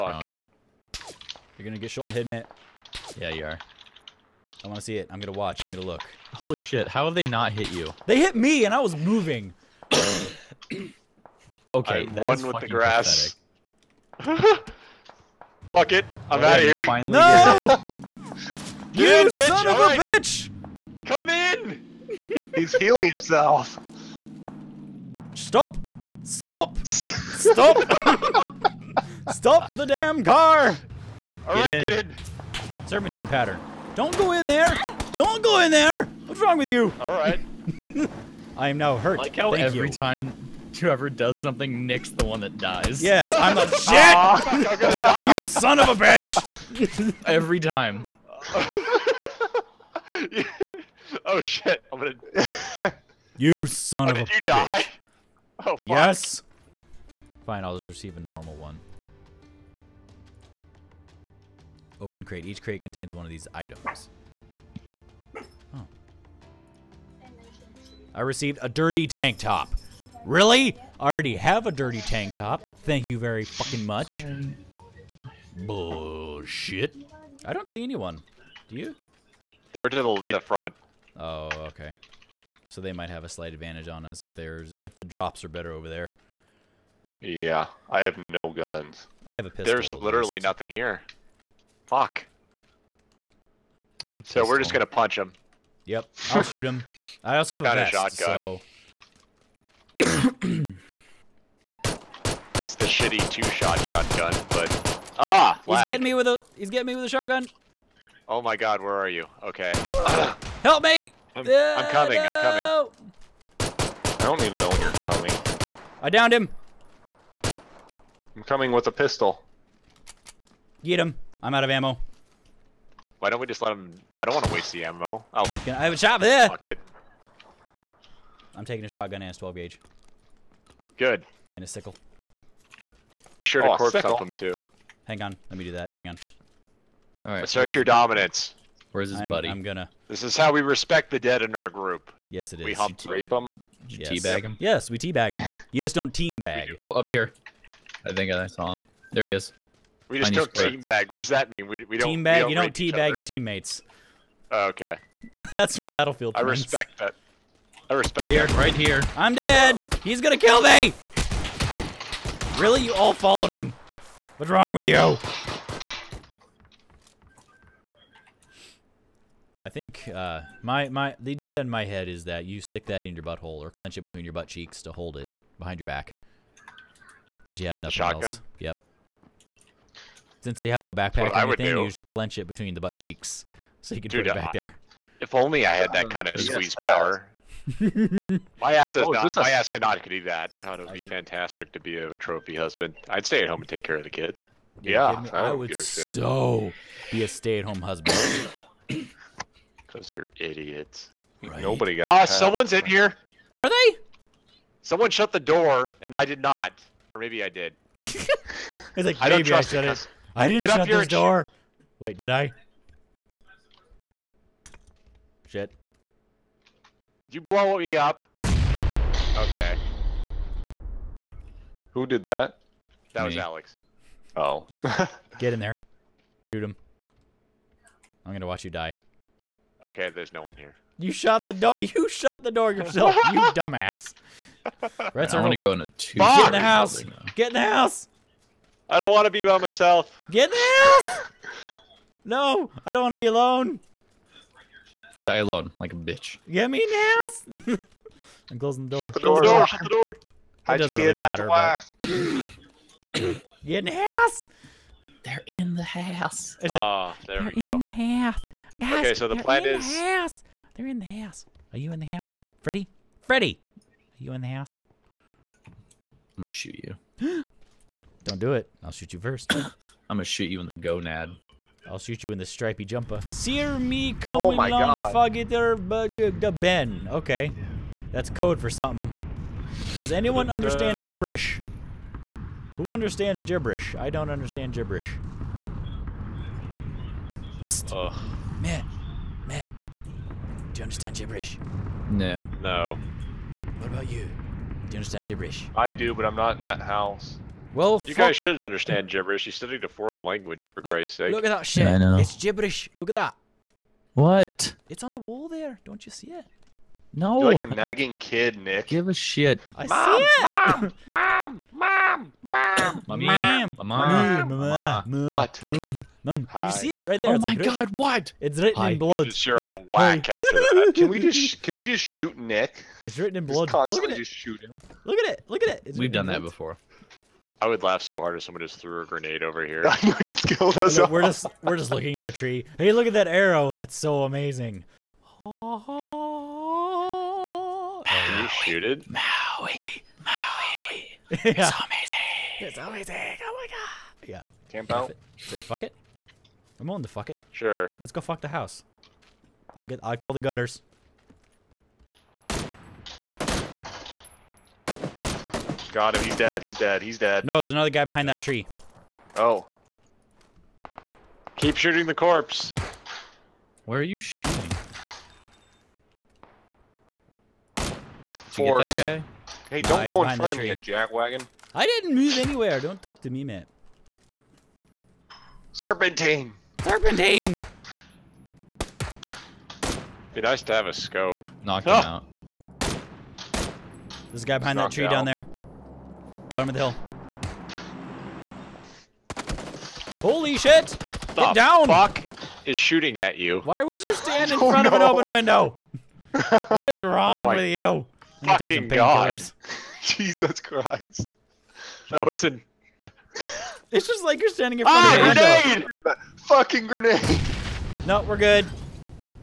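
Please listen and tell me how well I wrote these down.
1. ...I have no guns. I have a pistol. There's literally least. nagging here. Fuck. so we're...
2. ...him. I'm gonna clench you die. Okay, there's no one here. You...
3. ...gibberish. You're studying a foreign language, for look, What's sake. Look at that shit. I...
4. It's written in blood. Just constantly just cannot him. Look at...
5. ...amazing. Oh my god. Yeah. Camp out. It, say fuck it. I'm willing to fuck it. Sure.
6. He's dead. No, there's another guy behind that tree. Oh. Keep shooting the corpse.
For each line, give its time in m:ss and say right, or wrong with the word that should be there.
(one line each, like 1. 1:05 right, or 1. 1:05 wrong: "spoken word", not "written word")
1. 1:27 wrong: "nothing", not "nagging"
2. 3:46 wrong: "watch", not "clench"
3. 4:59 wrong: "Christ", not "What"
4. 5:23 wrong: "shoot", not "cannot"
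5. 5:42 right
6. 5:57 right.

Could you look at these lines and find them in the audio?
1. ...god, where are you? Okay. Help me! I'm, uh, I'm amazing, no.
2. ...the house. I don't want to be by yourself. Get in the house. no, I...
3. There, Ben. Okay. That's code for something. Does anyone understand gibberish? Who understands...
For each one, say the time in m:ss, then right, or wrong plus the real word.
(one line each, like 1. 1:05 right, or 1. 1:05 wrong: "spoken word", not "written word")
1. 1:48 wrong: "coming", not "amazing"
2. 3:57 wrong: "myself", not "yourself"
3. 4:35 right.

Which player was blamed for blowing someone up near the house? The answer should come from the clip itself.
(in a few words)
Alex.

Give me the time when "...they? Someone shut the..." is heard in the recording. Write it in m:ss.
3:23.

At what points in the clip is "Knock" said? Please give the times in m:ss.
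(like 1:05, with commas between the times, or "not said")
6:21.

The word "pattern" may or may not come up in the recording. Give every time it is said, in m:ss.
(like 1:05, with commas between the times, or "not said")
0:33.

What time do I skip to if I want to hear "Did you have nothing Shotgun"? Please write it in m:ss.
2:57.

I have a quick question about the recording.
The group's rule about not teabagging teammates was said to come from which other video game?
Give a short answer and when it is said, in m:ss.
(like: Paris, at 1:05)
Battlefield, at 2:35.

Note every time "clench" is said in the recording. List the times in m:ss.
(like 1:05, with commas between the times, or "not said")
2:53, 3:02.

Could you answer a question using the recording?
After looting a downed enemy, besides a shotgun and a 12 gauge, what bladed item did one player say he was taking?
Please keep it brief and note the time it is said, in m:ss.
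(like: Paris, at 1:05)
sickle, at 2:11.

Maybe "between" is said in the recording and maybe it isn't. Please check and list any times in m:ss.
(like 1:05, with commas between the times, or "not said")
2:54, 3:02.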